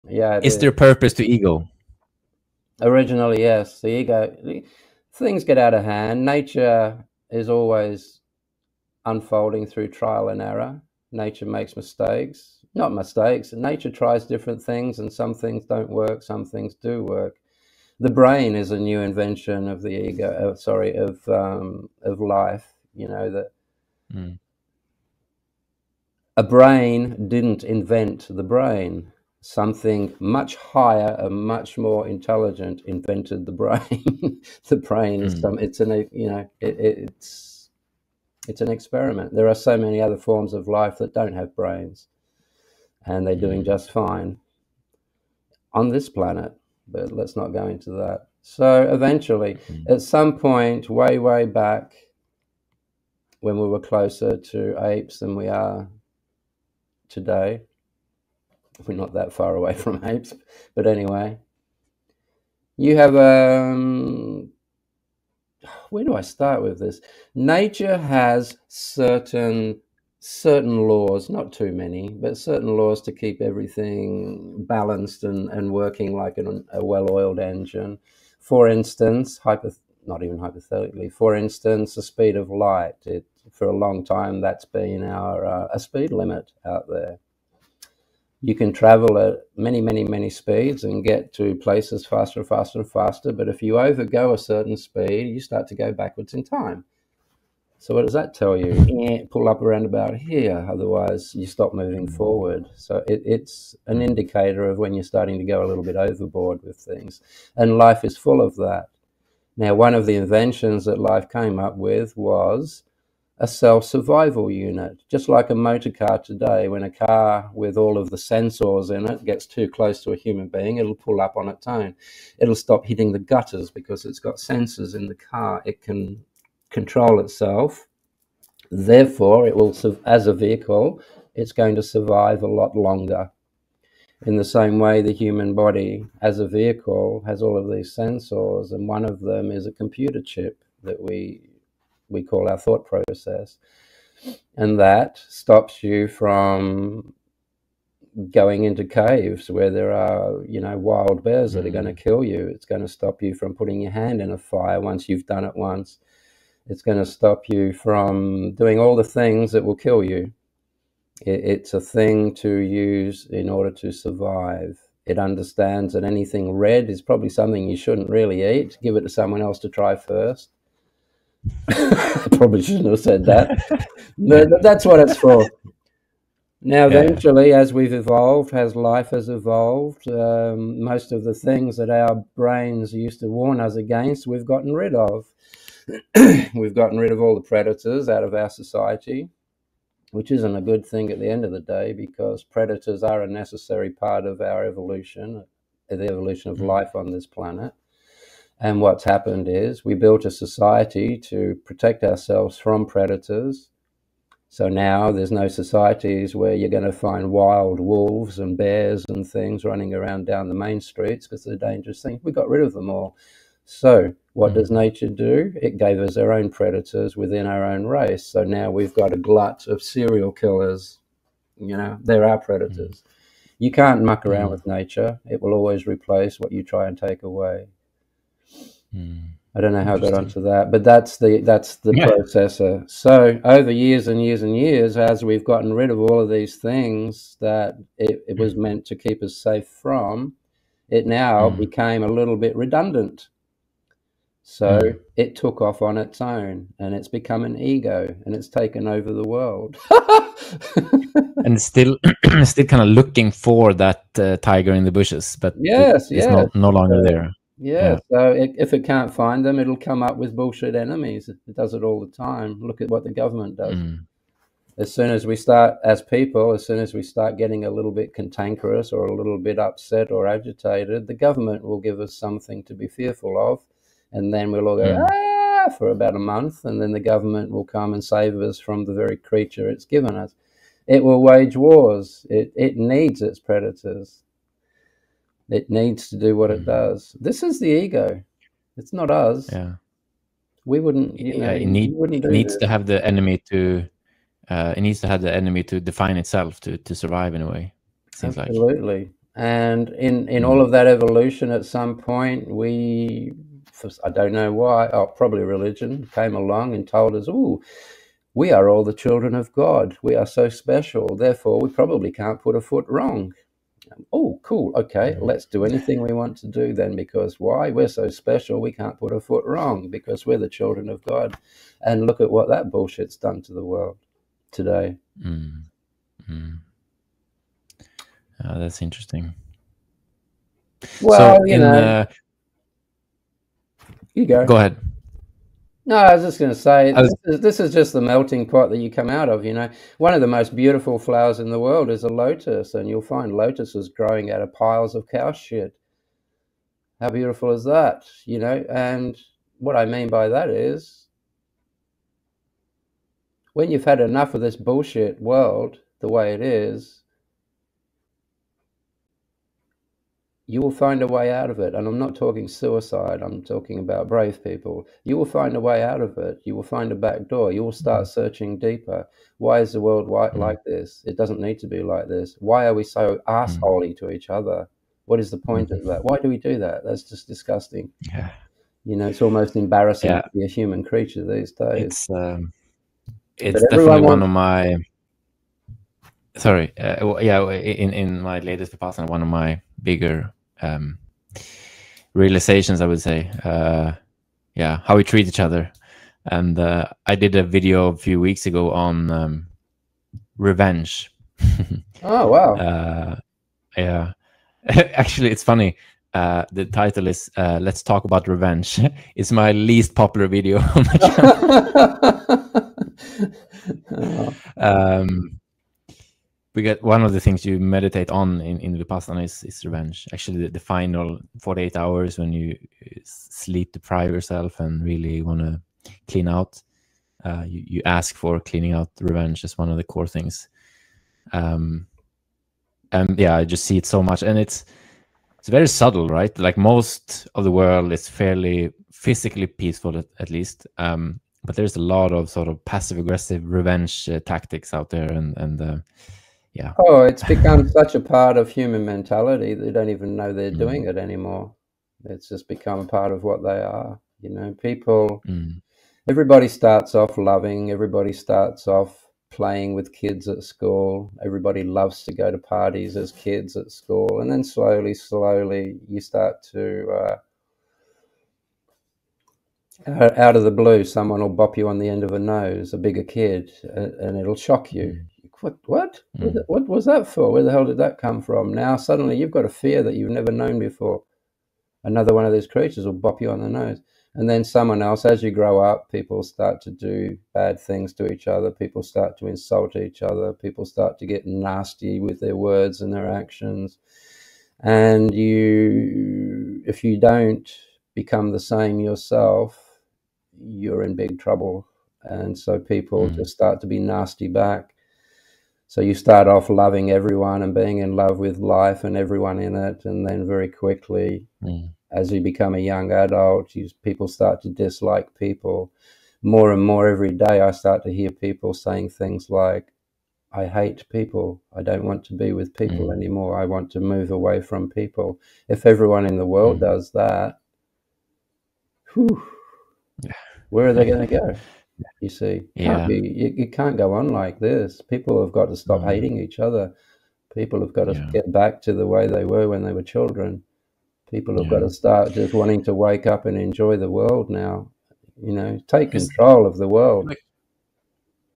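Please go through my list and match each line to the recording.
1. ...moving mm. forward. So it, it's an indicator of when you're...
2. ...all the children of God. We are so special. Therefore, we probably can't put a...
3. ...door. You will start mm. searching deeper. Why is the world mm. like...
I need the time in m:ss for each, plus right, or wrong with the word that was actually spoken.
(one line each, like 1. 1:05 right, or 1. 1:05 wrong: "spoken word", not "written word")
1. 1:41 right
2. 5:08 right
3. 6:07 right.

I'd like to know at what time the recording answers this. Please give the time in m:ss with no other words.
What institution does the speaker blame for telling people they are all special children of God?
5:05.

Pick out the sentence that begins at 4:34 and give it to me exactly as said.
And then we'll all go, yeah.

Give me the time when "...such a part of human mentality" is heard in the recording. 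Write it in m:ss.
7:27.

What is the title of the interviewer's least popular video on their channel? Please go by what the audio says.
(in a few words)
Let's Talk About Revenge.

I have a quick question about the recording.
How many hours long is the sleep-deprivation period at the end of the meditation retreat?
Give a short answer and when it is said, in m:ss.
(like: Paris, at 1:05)
48, at 7:01.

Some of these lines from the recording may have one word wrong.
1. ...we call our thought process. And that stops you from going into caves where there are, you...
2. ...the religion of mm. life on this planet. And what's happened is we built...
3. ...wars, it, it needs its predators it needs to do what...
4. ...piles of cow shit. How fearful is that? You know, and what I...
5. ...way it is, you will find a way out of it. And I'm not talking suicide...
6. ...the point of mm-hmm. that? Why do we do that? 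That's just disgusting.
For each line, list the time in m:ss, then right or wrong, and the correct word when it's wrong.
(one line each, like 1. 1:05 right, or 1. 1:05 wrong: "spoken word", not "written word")
1. 2:22 right
2. 3:15 wrong: "evolution", not "religion"
3. 4:41 right
4. 5:44 wrong: "beautiful", not "fearful"
5. 5:56 right
6. 6:15 right.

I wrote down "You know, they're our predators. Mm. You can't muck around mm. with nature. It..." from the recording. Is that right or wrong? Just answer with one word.
right.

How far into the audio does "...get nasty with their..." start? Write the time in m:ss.
8:11.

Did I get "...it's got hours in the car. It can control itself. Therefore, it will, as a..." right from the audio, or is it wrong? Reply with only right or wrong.
wrong.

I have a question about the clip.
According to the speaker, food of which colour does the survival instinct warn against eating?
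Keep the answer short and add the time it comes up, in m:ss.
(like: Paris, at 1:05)
red, at 2:46.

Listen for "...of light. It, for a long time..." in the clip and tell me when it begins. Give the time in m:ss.
1:22.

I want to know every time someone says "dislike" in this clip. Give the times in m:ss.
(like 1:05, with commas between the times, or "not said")
8:34.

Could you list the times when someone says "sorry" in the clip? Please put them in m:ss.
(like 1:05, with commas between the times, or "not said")
0:20, 6:26.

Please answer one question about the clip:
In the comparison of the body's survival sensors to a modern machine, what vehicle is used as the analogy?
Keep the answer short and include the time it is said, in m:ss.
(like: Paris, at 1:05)
motor car, at 1:55.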